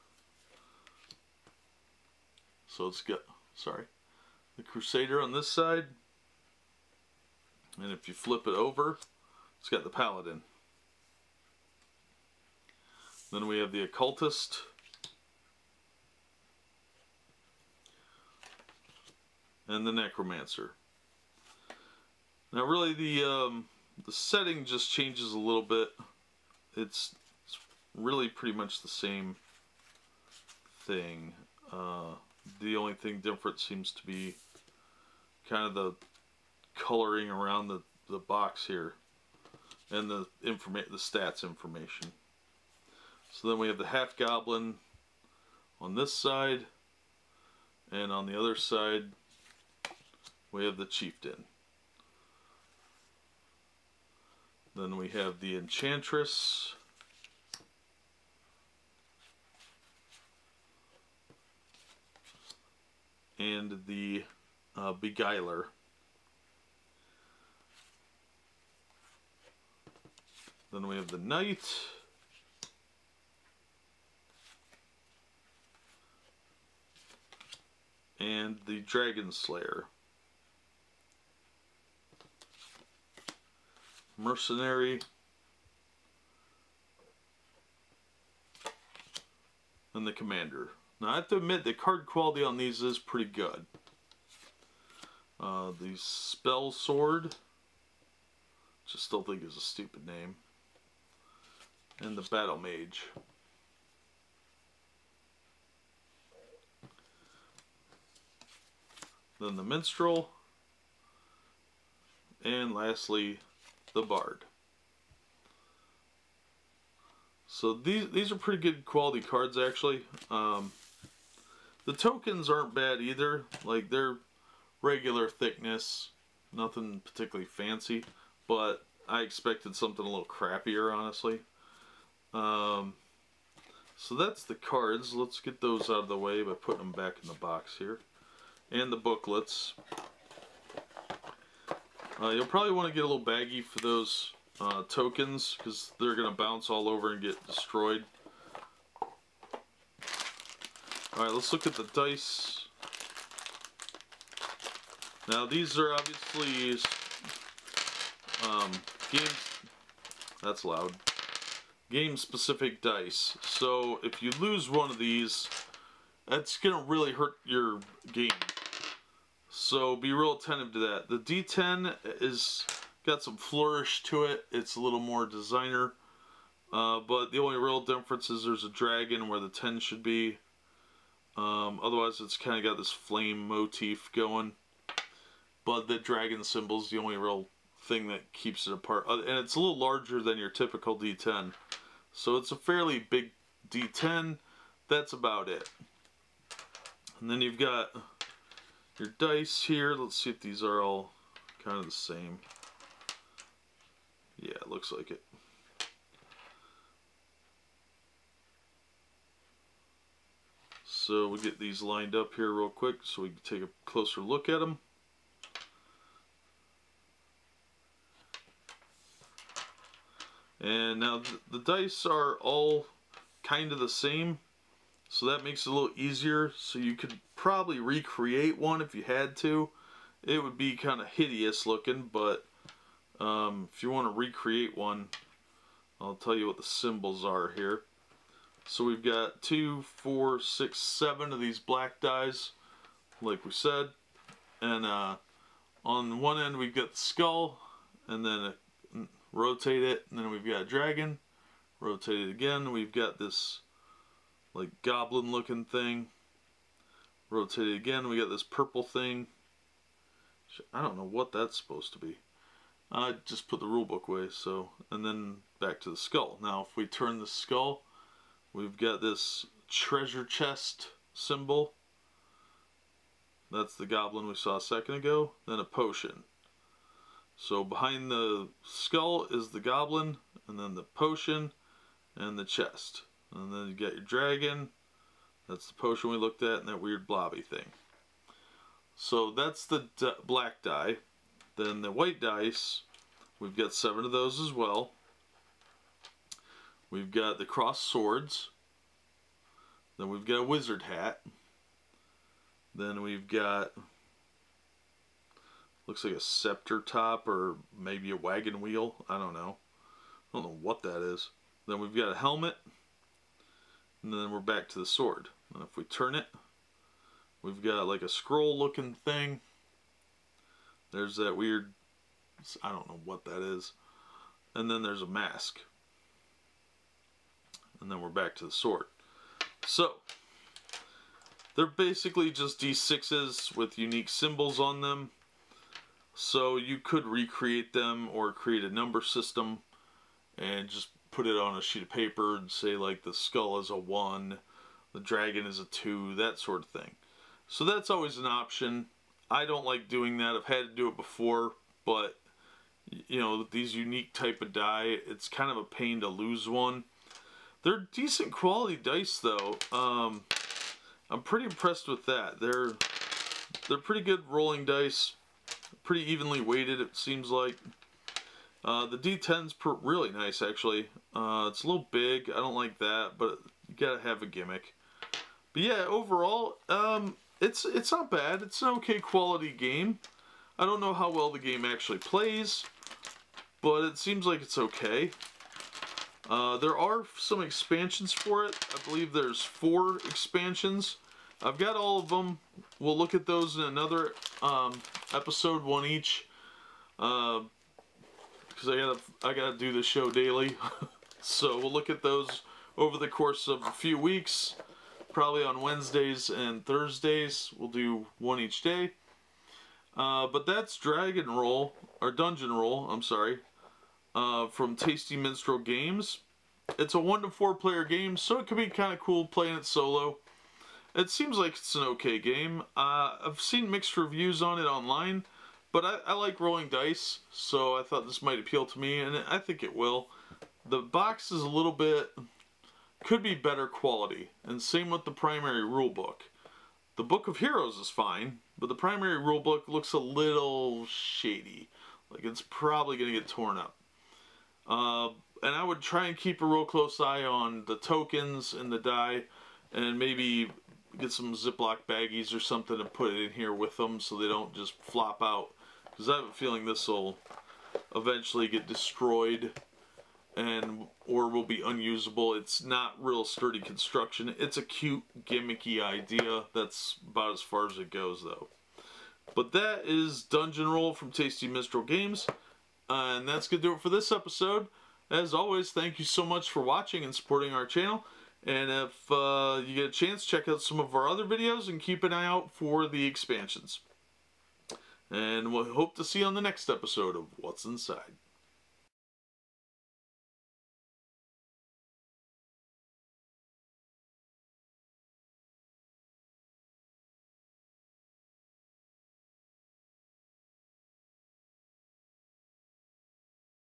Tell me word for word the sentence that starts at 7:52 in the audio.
Uh, and that's going to do it for this episode.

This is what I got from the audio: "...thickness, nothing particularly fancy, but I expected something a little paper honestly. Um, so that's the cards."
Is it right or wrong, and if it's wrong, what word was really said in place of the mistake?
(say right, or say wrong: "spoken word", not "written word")
wrong: "crappier", not "paper".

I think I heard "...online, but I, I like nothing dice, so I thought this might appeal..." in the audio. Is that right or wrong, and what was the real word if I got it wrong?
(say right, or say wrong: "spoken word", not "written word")
wrong: "rolling", not "nothing".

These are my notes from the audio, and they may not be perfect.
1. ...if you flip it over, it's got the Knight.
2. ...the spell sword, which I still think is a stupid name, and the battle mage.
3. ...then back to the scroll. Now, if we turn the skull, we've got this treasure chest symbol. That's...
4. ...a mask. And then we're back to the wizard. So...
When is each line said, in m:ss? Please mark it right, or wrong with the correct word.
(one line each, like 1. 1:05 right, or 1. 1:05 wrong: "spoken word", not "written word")
1. 0:07 wrong: "Paladin", not "Knight"
2. 1:35 right
3. 4:25 wrong: "skull", not "scroll"
4. 5:25 wrong: "sword", not "wizard".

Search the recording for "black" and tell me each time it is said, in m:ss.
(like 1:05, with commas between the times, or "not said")
4:01, 4:50.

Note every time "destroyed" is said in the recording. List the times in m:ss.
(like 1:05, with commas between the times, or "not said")
2:27, 7:38.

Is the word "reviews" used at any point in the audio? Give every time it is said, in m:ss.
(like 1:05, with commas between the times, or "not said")
7:03.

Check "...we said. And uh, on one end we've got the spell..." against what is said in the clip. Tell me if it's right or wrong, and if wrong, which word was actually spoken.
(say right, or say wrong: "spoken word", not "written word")
wrong: "skull", not "spell".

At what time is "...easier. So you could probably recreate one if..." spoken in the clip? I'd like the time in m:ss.
3:45.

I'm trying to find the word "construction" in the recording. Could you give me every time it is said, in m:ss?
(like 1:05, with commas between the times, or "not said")
7:43.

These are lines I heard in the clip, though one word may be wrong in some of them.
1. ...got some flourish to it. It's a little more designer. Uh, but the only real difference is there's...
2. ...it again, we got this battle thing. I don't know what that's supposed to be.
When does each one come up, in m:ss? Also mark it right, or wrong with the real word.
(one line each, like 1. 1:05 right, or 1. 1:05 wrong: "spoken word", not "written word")
1. 2:53 right
2. 4:17 wrong: "purple", not "battle".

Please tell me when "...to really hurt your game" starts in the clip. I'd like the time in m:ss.
2:46.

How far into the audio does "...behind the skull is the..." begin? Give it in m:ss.
4:37.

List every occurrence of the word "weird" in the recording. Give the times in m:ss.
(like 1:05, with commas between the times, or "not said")
4:46, 5:21.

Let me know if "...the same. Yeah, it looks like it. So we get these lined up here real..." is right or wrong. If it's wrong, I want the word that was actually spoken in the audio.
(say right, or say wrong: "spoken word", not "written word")
right.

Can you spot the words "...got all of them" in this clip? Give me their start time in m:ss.
6:31.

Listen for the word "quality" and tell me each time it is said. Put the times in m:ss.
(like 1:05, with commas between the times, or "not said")
1:32, 1:58, 5:58, 6:18, 7:13.